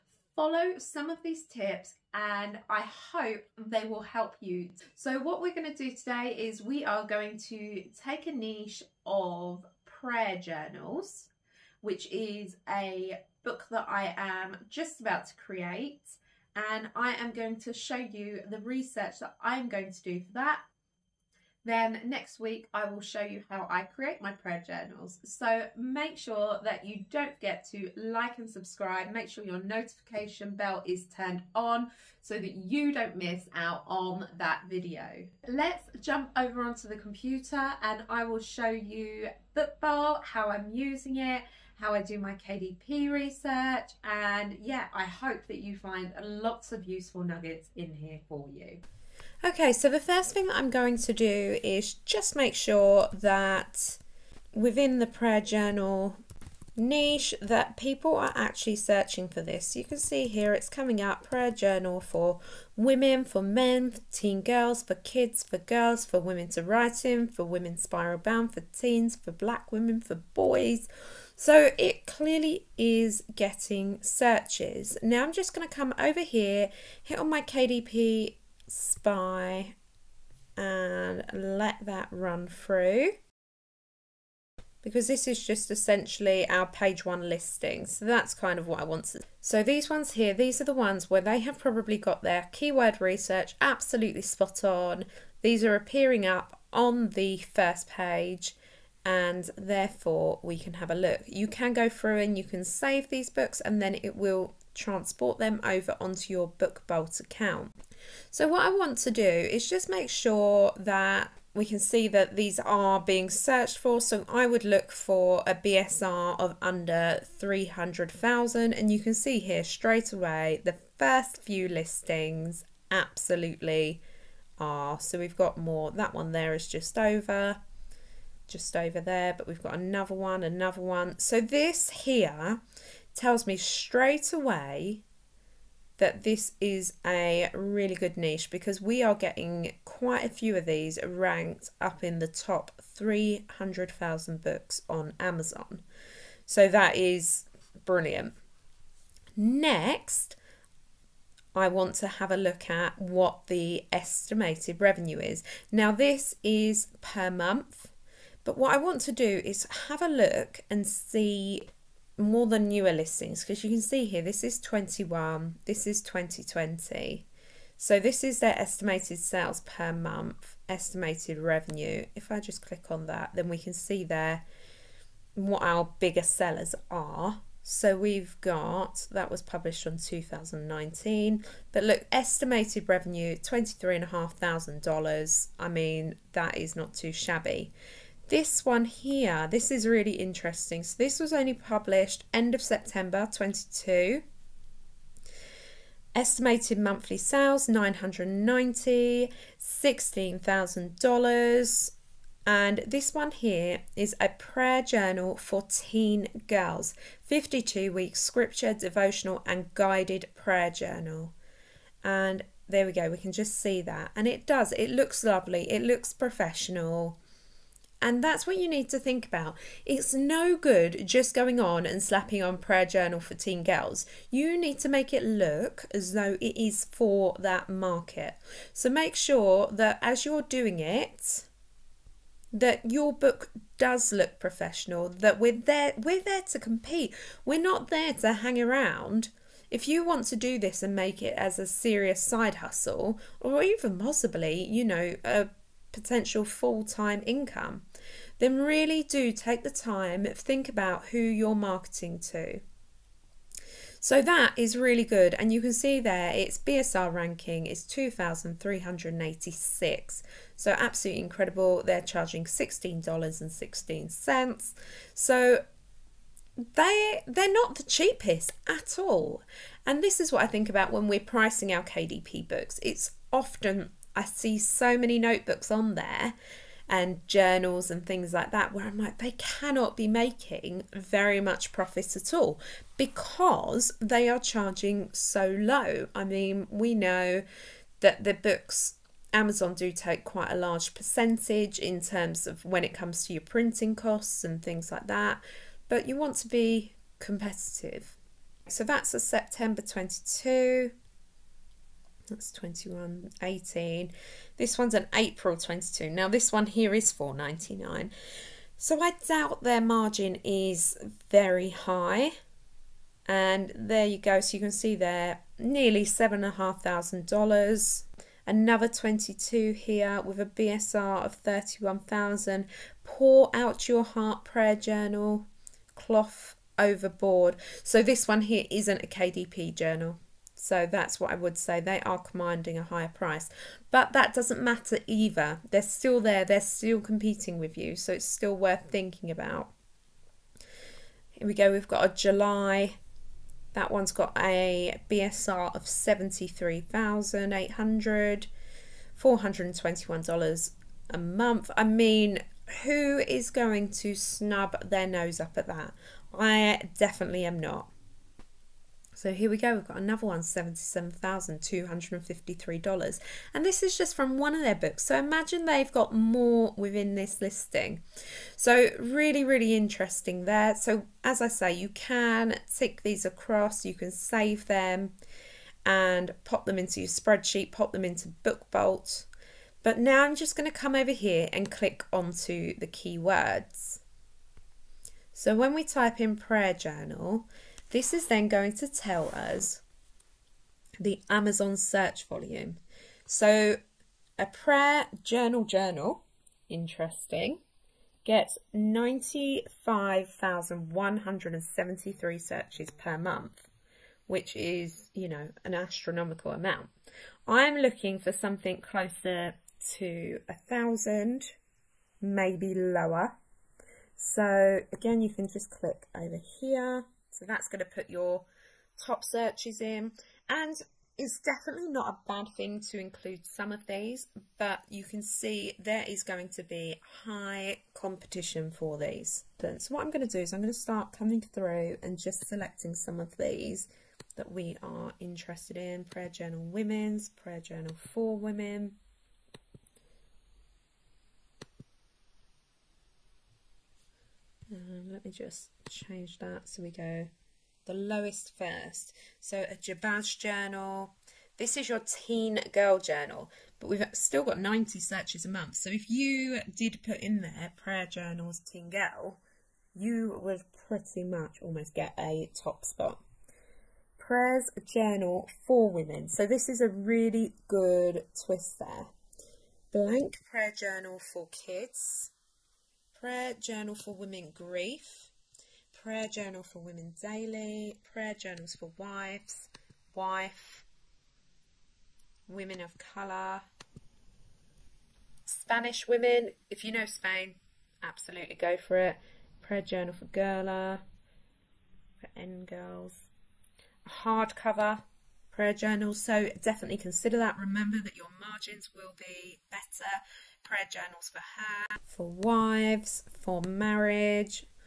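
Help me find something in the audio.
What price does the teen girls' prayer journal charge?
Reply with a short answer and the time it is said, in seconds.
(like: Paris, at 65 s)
$16.16, at 262 s.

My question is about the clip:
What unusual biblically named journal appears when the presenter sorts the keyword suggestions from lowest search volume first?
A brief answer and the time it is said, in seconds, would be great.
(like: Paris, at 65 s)
Jabez journal, at 449 s.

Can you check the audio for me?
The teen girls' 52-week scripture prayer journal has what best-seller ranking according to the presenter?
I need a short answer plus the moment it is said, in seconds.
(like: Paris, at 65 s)
2,386, at 257 s.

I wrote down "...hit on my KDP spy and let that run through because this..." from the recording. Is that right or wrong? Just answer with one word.
right.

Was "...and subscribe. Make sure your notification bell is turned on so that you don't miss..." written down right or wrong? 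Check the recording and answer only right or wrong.
right.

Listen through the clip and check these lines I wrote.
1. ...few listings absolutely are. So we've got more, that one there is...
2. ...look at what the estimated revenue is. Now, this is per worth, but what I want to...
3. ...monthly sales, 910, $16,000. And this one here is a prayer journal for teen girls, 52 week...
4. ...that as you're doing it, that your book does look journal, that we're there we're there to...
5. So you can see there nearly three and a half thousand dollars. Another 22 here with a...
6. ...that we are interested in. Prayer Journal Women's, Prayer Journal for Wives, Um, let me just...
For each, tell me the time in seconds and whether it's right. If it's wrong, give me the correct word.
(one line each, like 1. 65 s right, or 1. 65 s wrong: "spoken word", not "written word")
1. 121 s right
2. 152 s wrong: "month", not "worth"
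3. 196 s wrong: "990", not "910"
4. 229 s wrong: "professional", not "journal"
5. 314 s wrong: "seven", not "three"
6. 434 s wrong: "Women", not "Wives".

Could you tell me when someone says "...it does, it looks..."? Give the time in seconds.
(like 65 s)
214 s.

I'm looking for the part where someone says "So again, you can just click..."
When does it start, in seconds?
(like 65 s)
414 s.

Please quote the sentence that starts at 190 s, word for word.
So this was only published end of September 22.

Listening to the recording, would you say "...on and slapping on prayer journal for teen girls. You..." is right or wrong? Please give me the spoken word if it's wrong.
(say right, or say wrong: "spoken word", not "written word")
right.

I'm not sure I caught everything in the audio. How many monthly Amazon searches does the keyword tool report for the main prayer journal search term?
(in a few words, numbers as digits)
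95,173.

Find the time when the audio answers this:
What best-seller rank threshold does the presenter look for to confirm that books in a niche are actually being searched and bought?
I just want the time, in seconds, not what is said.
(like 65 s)
116 s.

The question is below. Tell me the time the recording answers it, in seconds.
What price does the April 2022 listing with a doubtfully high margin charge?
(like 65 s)
307 s.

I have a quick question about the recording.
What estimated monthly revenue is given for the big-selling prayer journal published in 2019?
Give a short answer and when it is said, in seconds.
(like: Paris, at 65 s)
$23,500, at 183 s.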